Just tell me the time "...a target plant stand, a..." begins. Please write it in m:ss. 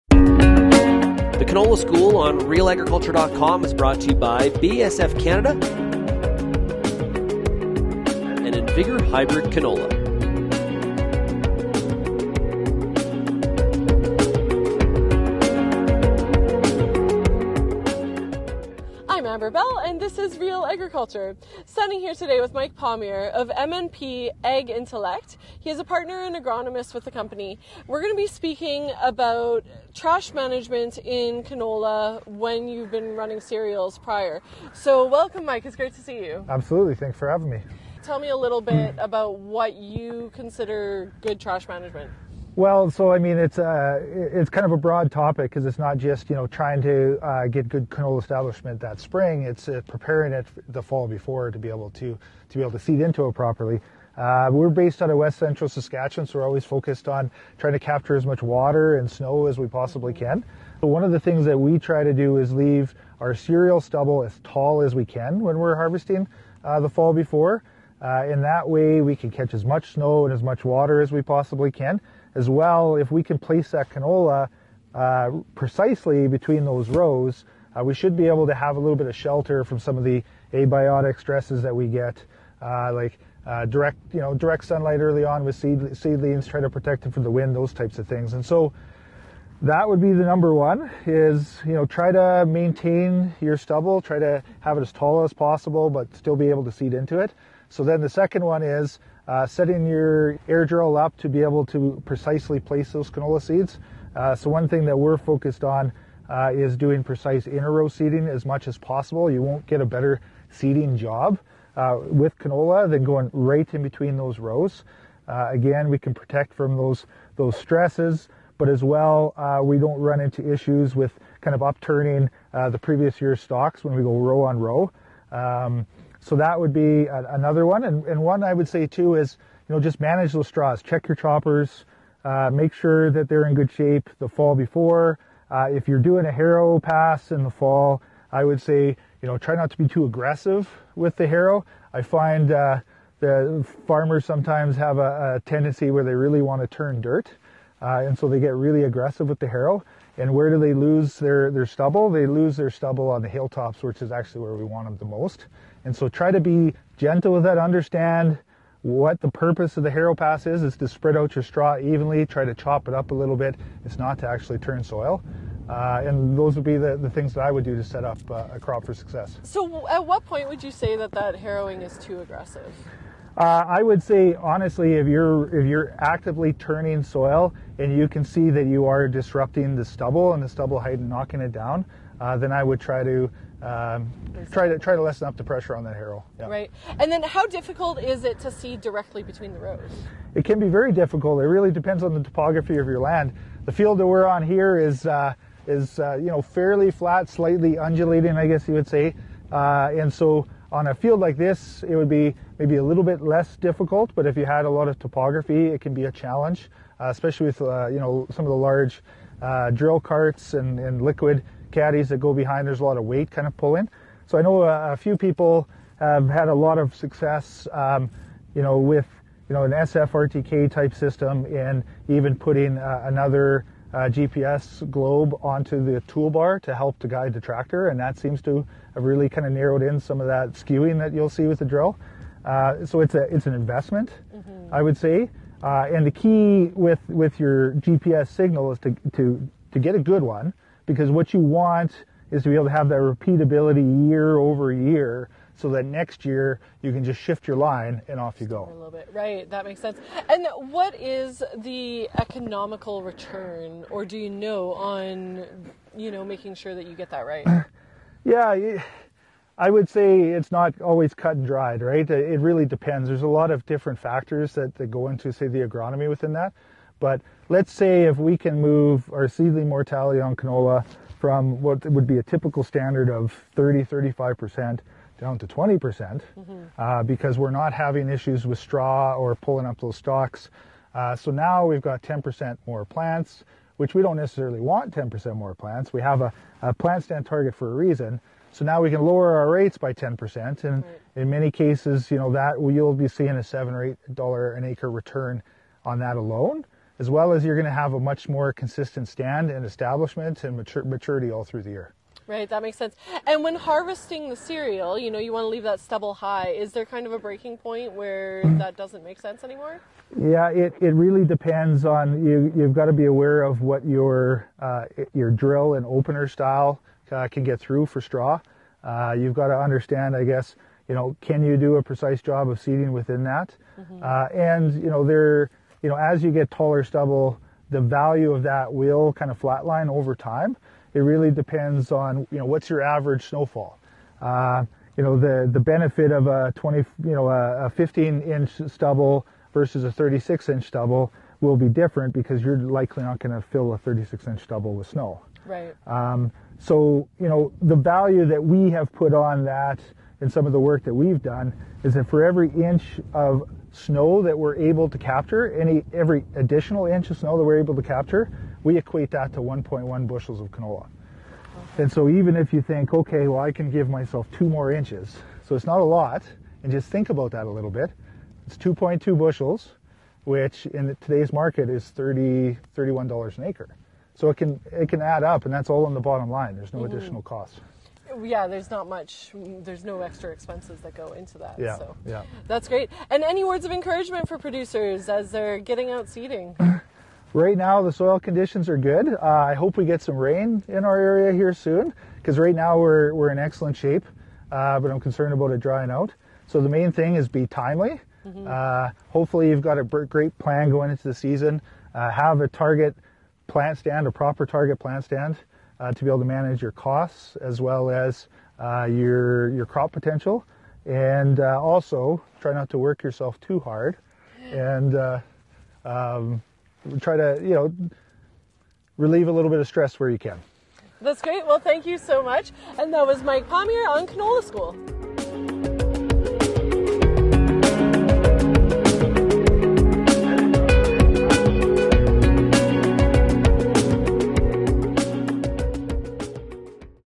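6:42.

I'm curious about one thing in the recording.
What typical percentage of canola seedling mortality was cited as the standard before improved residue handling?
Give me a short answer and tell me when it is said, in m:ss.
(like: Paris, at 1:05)
30 to 35%, at 4:33.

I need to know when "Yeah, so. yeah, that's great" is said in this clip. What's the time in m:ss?
6:21.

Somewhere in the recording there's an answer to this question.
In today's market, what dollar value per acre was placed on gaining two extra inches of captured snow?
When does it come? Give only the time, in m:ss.
6:11.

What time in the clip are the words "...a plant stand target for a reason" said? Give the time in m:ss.
4:46.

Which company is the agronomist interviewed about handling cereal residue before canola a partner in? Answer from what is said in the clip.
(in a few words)
MNP Ag Intellect.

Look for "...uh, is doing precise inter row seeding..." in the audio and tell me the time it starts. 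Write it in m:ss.
1:46.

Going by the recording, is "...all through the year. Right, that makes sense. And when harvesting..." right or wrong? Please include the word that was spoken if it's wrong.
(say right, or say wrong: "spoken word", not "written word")
right.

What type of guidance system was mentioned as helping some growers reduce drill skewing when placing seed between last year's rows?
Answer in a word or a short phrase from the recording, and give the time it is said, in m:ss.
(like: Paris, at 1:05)
SFRTK, at 3:39.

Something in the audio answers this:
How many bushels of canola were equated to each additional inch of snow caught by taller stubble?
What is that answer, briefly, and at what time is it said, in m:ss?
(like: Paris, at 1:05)
1.1 bushels, at 5:59.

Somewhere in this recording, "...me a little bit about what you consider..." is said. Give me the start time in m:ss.
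0:38.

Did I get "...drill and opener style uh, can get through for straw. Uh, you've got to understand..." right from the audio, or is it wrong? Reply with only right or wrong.
right.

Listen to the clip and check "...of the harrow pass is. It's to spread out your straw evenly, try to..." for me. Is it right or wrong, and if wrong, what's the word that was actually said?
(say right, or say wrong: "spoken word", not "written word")
right.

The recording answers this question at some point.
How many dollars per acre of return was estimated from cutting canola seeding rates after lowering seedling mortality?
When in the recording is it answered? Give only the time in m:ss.
4:53.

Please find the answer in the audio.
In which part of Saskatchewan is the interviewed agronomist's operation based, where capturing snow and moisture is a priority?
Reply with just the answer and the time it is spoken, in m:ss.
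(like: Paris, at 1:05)
West Central Saskatchewan, at 0:55.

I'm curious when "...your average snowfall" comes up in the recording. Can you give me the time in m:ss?
5:32.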